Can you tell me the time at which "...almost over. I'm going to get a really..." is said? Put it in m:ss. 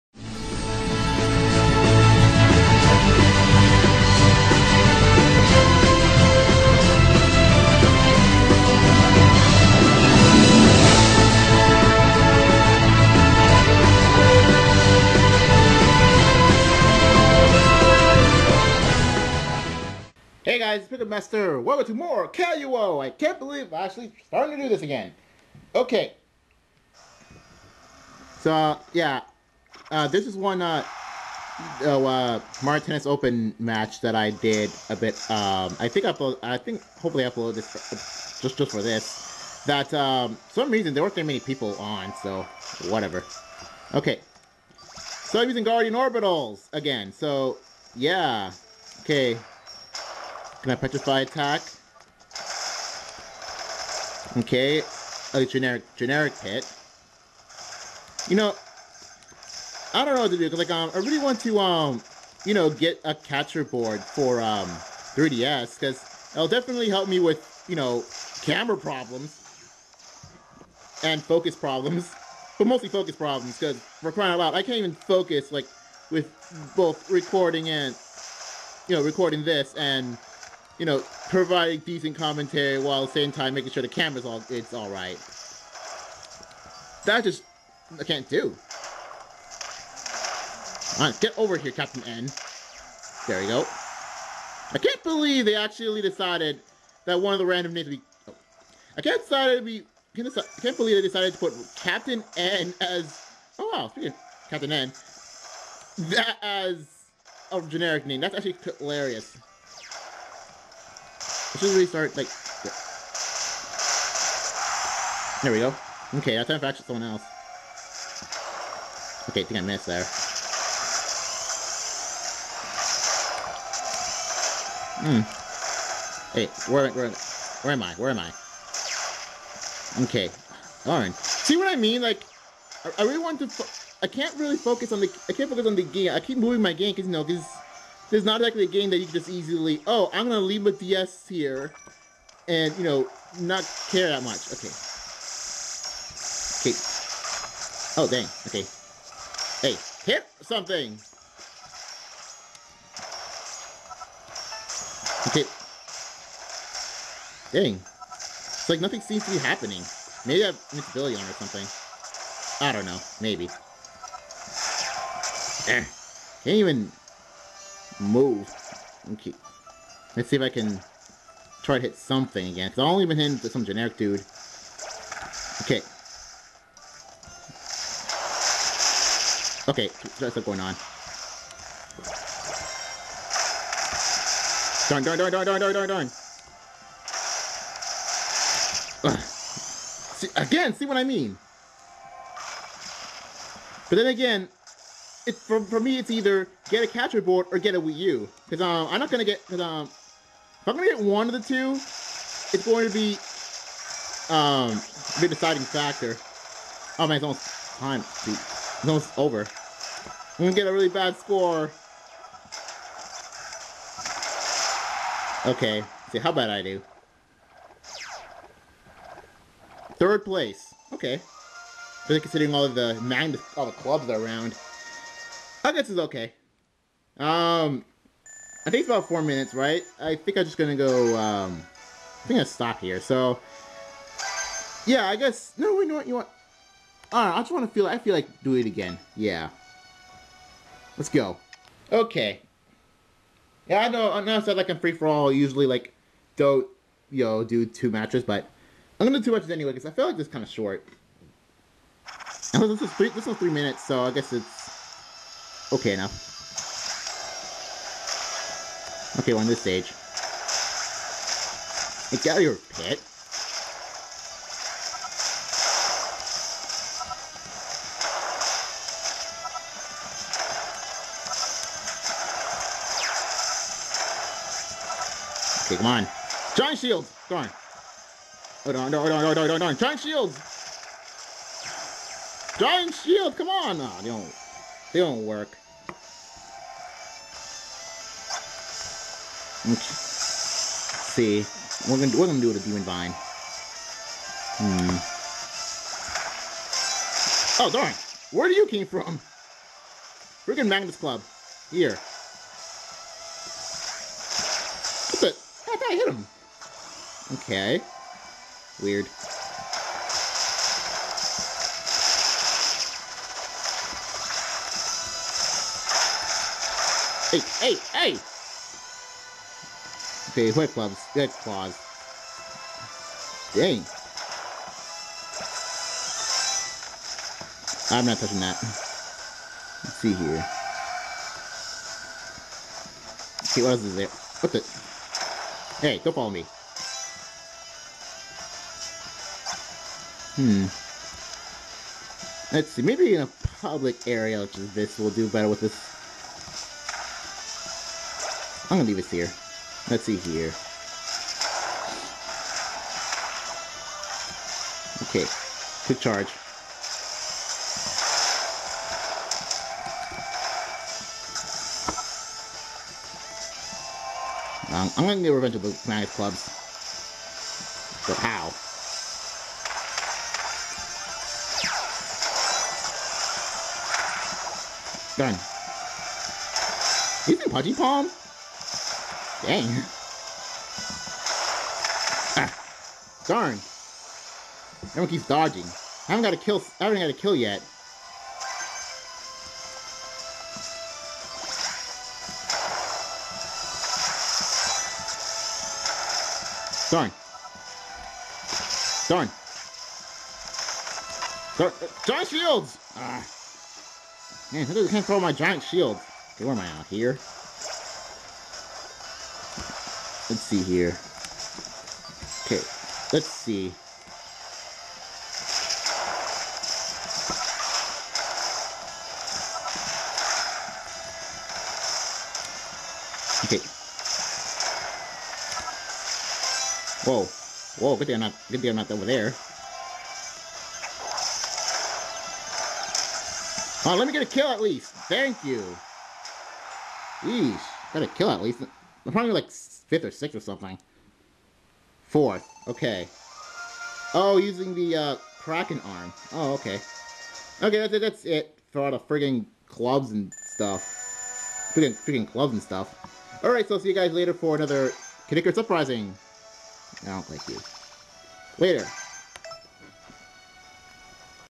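3:28.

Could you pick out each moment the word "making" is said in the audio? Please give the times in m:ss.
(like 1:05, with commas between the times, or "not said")
1:23.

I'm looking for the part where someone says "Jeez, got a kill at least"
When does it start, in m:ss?
7:17.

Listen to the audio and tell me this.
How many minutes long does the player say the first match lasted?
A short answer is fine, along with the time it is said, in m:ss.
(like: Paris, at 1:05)
3, at 4:13.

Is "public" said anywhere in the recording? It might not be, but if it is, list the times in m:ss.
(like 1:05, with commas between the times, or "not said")
5:43.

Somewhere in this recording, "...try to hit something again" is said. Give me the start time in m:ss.
2:51.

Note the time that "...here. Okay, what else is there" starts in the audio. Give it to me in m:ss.
5:30.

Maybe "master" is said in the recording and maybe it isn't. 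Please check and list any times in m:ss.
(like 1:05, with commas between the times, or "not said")
0:21.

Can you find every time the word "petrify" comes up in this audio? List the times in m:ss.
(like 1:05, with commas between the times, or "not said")
0:50.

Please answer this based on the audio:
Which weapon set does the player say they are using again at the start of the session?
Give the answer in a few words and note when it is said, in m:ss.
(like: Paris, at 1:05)
Guardian Orbitals, at 0:45.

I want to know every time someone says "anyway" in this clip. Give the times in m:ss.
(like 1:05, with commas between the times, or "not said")
4:09.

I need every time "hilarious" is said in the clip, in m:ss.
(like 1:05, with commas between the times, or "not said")
1:48.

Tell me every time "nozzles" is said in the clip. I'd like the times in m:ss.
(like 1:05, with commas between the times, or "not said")
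not said.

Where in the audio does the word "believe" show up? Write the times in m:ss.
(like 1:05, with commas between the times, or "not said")
0:23, 1:35, 1:40.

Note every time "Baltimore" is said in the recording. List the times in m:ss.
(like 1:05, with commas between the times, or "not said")
not said.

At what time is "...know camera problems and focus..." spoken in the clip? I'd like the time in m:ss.
1:07.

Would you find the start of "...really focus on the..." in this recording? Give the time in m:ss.
2:14.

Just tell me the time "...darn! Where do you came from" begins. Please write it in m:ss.
4:57.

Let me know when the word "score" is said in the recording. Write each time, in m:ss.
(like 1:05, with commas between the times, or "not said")
3:31.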